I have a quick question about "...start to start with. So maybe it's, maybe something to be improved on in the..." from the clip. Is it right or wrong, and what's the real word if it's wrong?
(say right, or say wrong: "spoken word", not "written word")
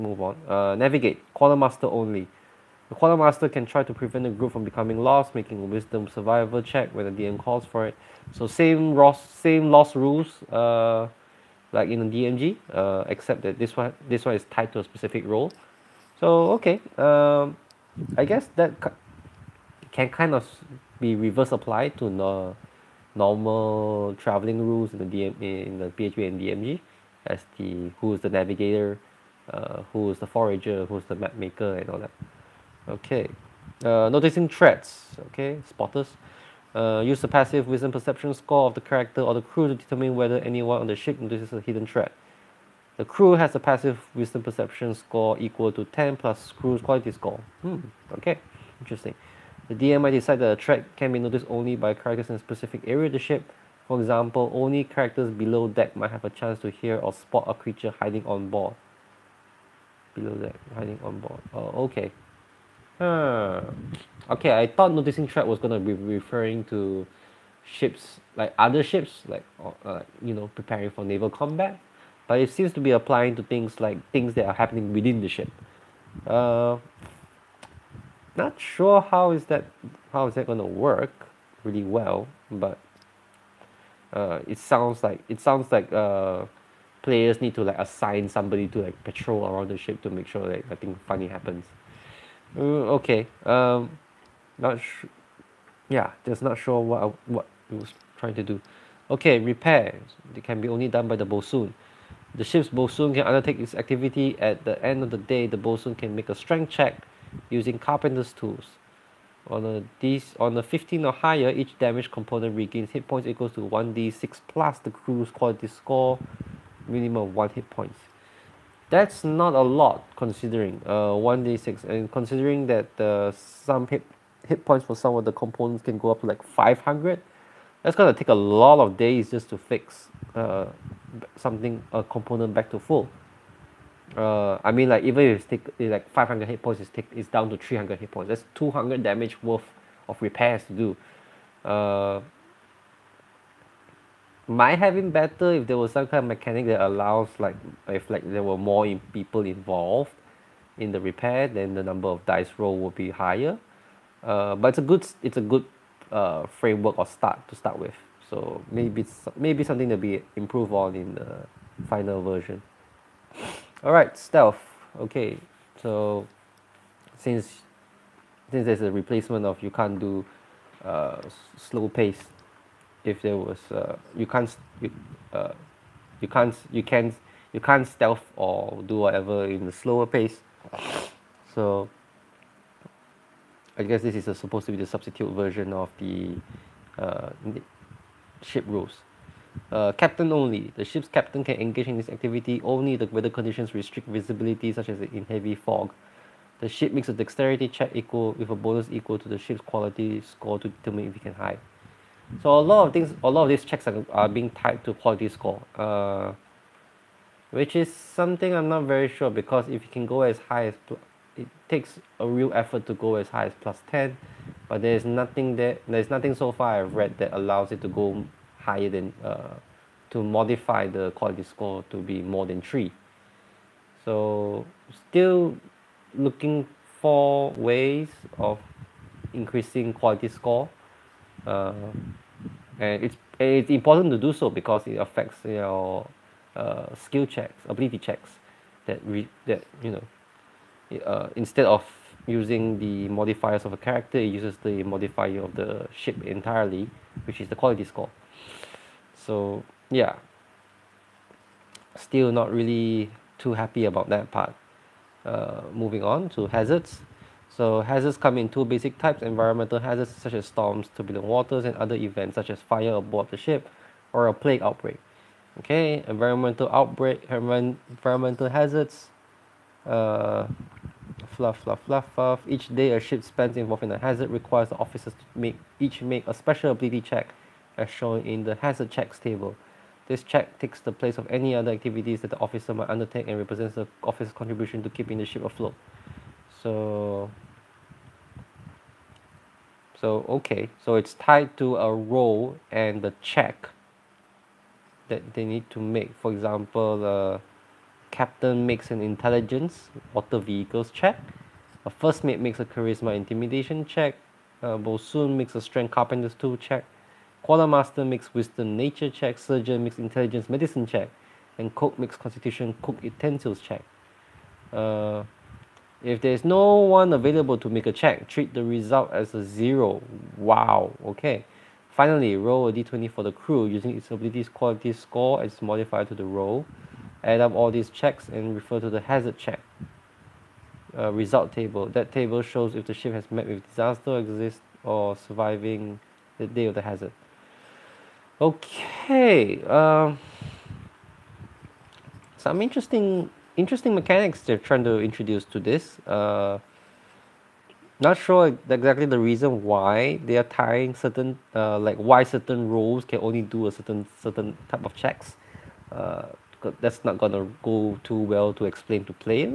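right.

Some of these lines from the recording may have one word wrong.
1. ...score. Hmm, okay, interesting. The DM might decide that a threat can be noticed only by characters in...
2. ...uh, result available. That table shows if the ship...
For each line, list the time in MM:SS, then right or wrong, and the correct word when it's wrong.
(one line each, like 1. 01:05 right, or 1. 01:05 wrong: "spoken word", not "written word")
1. 00:47 right
2. 05:30 wrong: "table", not "available".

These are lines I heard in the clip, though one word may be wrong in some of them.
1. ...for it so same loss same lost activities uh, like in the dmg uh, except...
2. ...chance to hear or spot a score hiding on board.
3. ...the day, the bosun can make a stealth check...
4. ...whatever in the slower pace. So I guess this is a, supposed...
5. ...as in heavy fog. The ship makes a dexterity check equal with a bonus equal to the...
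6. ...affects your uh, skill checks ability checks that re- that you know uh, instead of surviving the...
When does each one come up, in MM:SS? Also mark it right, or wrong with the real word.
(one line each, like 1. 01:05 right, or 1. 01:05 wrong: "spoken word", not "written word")
1. 00:07 wrong: "rules", not "activities"
2. 00:56 wrong: "creature", not "score"
3. 01:45 wrong: "strength", not "stealth"
4. 02:58 right
5. 03:14 right
6. 03:54 wrong: "using", not "surviving".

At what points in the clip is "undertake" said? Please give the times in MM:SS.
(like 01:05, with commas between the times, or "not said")
01:43, 04:42.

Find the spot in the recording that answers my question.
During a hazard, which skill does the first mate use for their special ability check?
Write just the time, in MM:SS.
05:02.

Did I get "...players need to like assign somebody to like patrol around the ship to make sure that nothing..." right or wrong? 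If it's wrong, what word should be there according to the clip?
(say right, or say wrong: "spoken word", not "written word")
right.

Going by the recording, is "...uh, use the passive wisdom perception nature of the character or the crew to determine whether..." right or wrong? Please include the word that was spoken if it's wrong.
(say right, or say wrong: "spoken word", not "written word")
wrong: "score", not "nature".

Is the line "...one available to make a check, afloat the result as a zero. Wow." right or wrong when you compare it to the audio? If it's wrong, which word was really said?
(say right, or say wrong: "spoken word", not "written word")
wrong: "treat", not "afloat".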